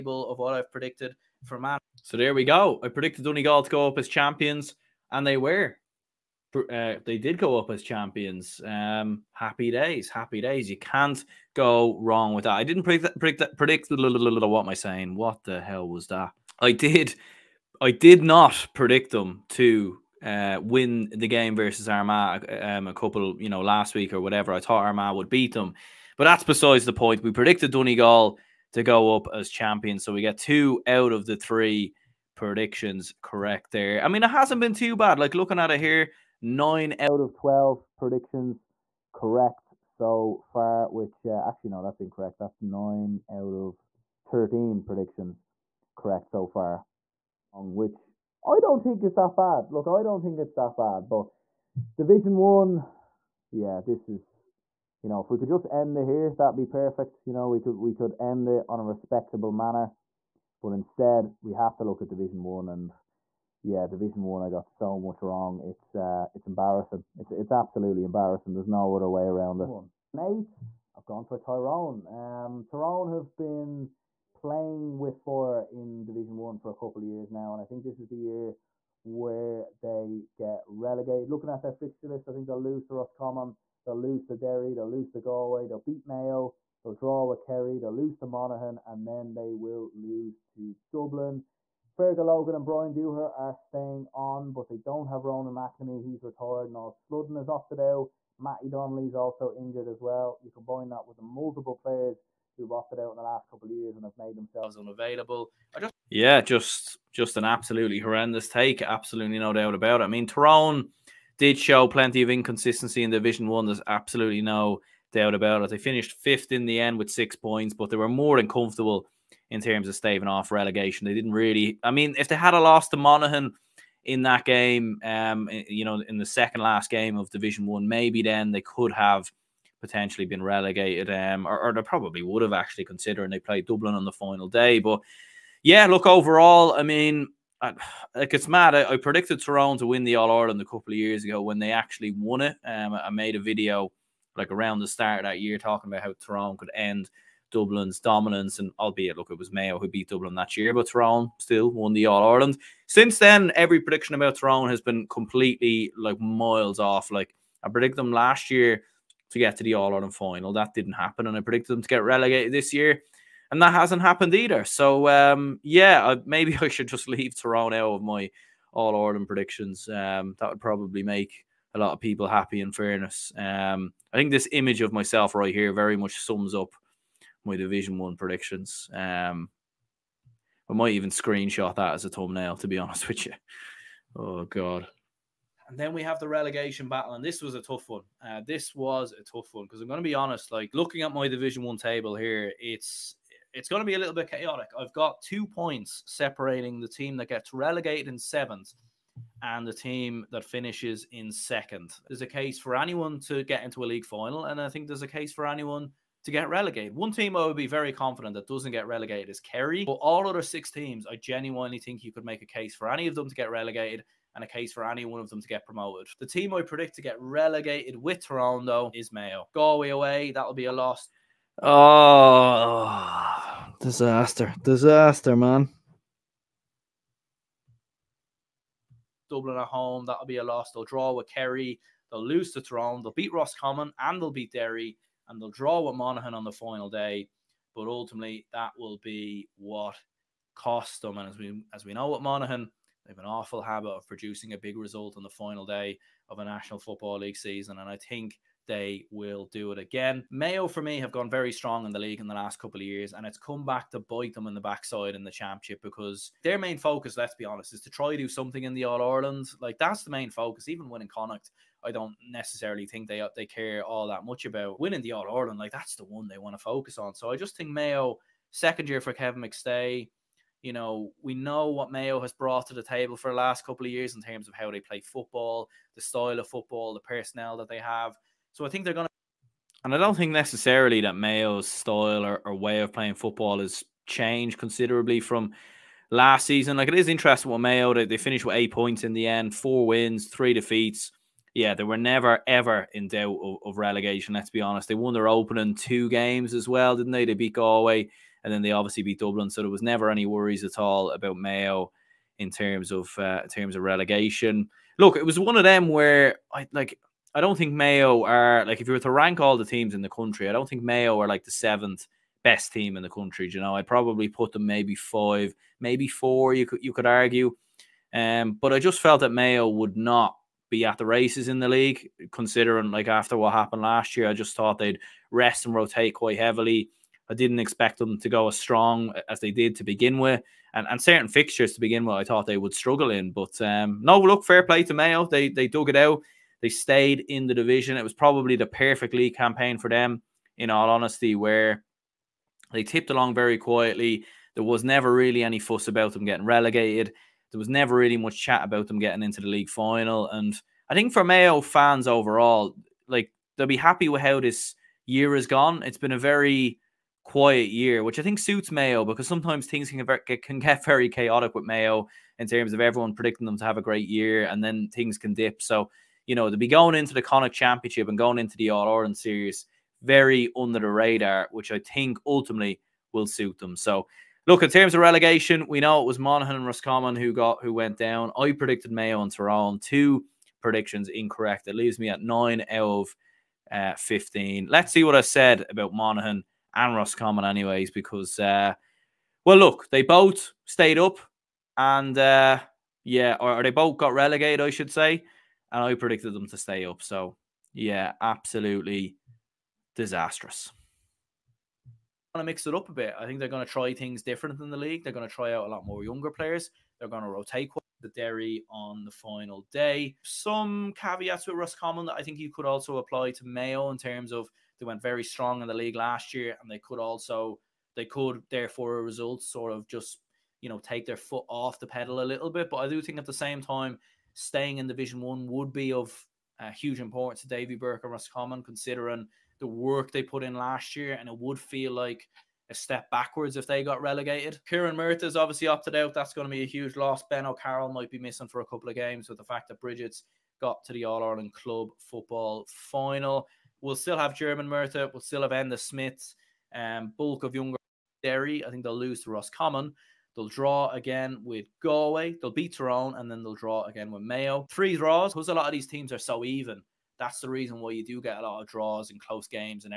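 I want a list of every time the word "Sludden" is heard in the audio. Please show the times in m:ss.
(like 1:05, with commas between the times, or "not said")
1:36.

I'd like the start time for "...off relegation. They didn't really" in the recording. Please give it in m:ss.
2:00.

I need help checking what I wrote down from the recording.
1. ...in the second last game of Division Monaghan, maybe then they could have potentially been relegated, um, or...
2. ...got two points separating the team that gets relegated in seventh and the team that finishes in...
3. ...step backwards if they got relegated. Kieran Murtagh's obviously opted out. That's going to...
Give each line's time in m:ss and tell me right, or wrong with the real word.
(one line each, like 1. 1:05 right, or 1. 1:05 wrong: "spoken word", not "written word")
1. 2:06 wrong: "One", not "Monaghan"
2. 3:14 right
3. 7:12 right.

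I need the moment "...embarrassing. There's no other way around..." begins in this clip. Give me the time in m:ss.
1:08.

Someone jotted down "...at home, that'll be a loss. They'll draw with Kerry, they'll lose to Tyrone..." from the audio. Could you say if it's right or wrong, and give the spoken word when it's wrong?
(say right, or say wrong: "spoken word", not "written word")
right.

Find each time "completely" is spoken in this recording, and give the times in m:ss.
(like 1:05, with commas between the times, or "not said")
2:35.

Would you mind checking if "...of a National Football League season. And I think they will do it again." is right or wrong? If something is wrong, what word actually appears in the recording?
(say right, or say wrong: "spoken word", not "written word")
right.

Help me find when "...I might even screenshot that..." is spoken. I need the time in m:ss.
3:00.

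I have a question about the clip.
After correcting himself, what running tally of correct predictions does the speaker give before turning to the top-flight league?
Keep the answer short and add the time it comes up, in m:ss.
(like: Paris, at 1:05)
9 out of 13, at 0:42.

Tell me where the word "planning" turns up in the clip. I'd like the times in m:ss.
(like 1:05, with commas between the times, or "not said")
not said.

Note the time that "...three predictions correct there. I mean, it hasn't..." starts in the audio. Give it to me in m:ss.
0:31.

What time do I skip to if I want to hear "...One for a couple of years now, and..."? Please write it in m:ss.
1:16.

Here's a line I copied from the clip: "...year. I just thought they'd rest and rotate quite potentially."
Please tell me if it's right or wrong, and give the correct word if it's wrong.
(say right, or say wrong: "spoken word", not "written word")
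wrong: "heavily", not "potentially".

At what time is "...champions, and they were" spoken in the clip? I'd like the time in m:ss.
0:04.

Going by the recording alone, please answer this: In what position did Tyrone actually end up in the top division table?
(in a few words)
Fifth.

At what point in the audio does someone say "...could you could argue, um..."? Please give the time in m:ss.
5:16.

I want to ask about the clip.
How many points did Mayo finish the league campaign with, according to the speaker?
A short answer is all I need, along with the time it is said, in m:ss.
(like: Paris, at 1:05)
8, at 4:48.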